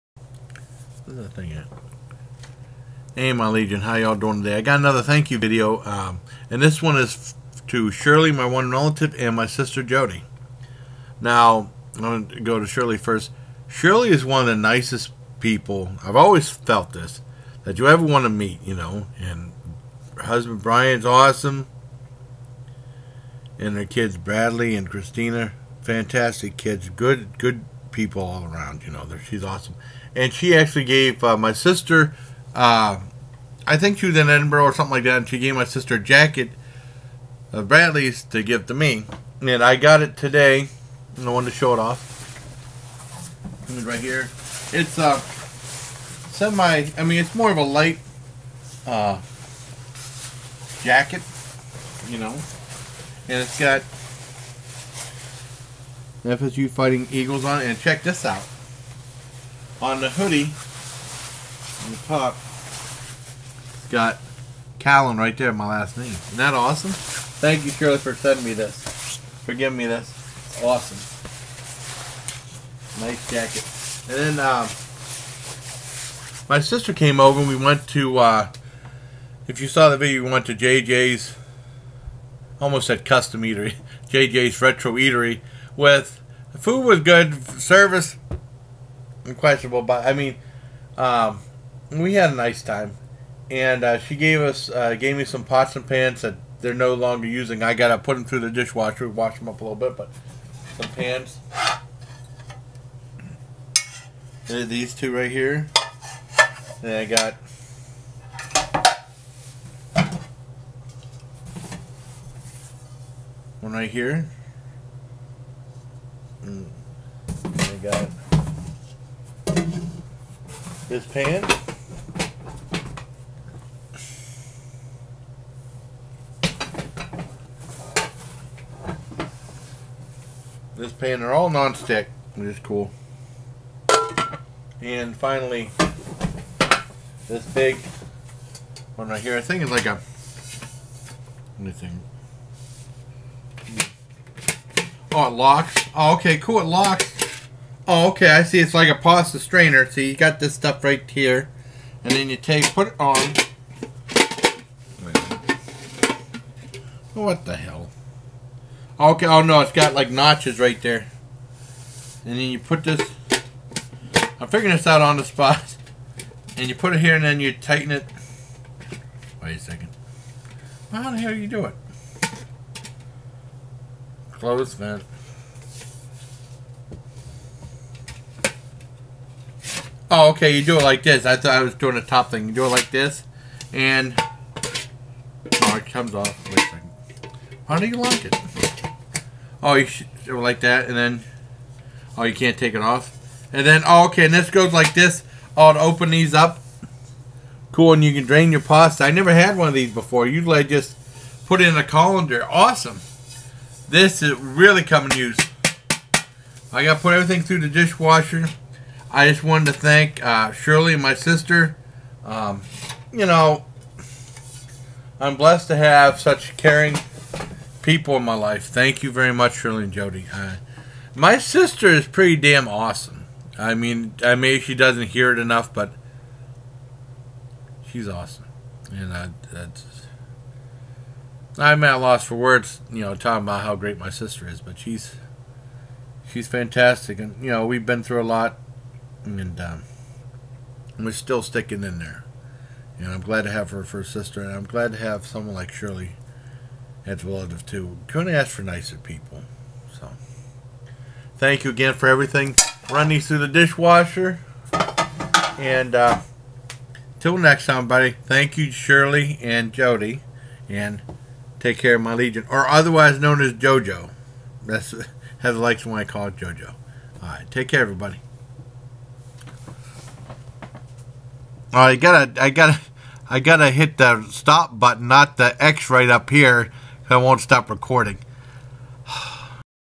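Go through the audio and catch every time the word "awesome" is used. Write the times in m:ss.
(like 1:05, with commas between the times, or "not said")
0:21, 0:29, 1:06, 1:10, 3:22, 3:42, 3:48.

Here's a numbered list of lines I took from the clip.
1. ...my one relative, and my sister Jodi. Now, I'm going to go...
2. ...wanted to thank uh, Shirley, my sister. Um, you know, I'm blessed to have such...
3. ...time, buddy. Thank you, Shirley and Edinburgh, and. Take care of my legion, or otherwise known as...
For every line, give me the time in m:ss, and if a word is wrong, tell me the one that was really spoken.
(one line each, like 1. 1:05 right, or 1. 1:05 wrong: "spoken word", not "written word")
1. 0:08 right
2. 3:29 right
3. 4:17 wrong: "Jodi", not "Edinburgh".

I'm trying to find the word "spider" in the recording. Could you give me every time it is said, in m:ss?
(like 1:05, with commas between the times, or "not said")
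not said.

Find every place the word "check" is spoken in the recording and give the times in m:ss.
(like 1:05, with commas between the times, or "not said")
0:57.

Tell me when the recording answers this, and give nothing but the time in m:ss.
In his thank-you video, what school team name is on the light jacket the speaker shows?
0:56.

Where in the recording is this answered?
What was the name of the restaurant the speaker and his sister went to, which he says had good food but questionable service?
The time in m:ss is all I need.
1:24.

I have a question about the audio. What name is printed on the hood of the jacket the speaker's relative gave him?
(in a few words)
Callan.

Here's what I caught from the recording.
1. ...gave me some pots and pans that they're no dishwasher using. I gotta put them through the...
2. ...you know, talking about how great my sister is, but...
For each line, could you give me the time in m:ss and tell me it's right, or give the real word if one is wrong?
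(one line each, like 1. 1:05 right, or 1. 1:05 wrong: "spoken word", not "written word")
1. 1:34 wrong: "longer", not "dishwasher"
2. 3:52 right.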